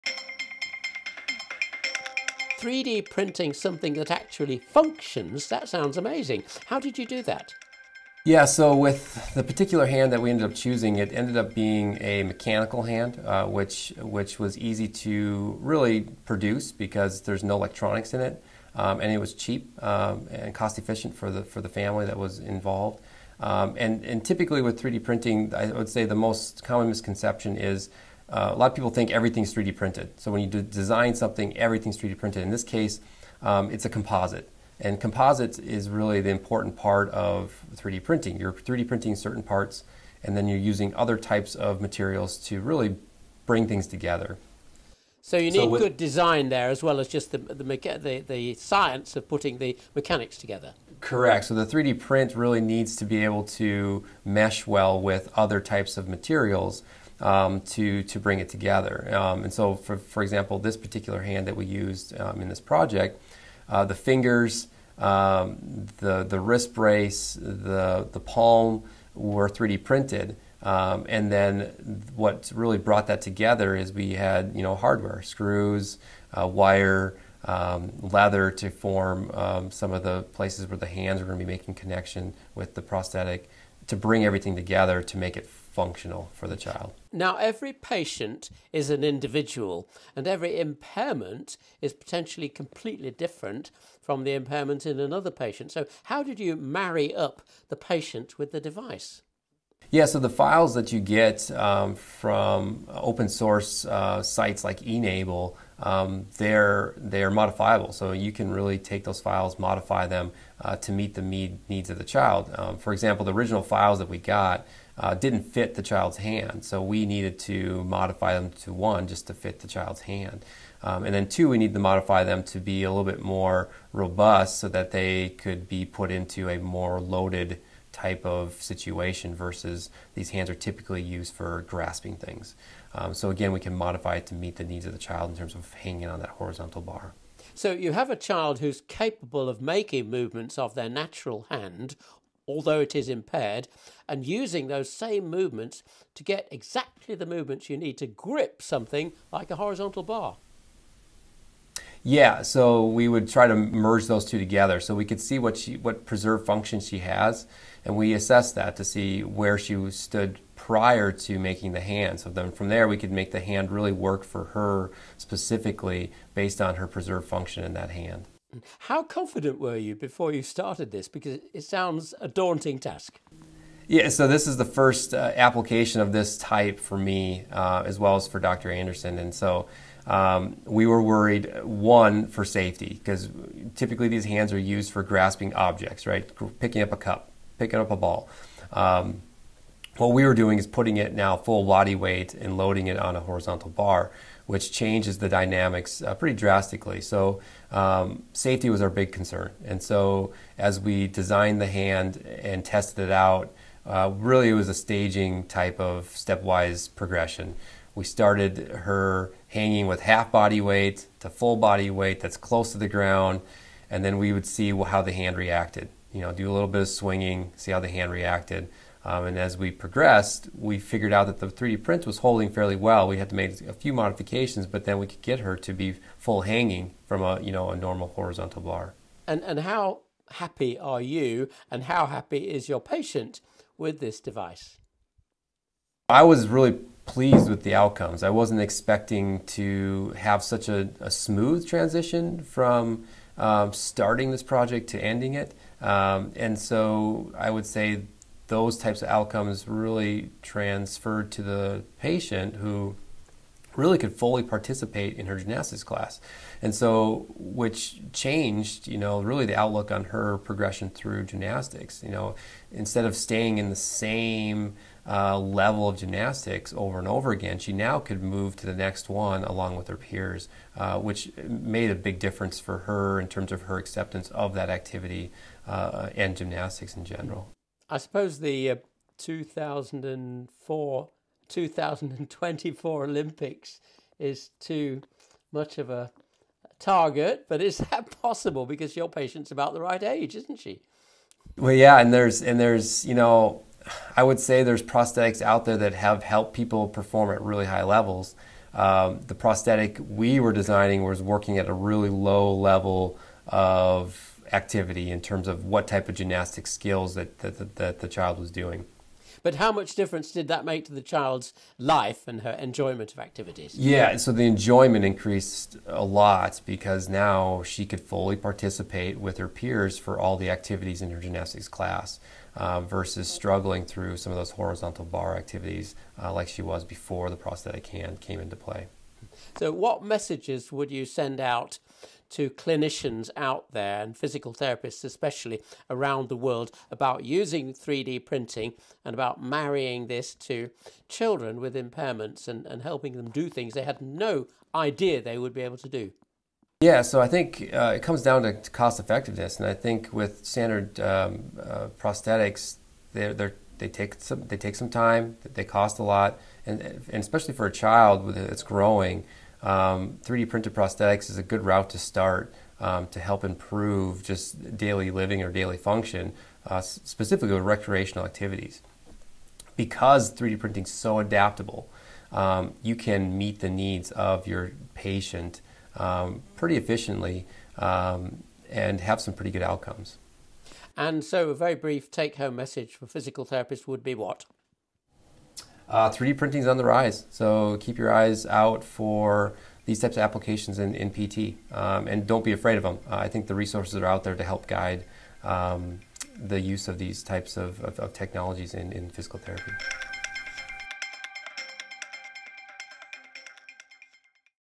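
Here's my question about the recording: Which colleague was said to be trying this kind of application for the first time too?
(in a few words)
Dr. Anderson.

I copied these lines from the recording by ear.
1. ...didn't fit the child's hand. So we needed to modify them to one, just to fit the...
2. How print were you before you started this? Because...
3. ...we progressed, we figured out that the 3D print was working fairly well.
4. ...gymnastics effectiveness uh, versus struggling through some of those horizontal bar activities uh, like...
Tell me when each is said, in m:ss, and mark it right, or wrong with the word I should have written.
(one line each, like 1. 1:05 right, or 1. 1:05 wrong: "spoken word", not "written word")
1. 1:55 right
2. 2:48 wrong: "confident", not "print"
3. 3:39 wrong: "holding", not "working"
4. 5:21 wrong: "class", not "effectiveness".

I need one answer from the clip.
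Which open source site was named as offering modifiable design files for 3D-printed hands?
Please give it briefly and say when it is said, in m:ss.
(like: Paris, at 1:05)
e-NABLE, at 1:44.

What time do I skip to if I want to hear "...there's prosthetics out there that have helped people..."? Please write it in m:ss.
4:54.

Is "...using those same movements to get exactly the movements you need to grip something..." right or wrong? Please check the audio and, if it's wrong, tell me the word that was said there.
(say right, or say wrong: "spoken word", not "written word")
right.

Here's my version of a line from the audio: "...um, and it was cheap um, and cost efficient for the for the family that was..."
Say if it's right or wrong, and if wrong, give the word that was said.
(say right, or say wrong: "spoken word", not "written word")
right.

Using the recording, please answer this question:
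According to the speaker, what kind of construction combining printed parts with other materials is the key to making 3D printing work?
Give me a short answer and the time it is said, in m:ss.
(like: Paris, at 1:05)
Composite, at 0:33.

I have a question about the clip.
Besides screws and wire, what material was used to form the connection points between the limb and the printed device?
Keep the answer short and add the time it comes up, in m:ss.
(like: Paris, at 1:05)
Leather, at 1:18.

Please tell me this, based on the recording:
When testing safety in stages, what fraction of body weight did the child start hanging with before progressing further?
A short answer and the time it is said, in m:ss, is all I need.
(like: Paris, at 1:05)
Half body weight, at 3:30.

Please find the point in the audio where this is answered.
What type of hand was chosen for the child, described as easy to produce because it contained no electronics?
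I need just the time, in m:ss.
0:12.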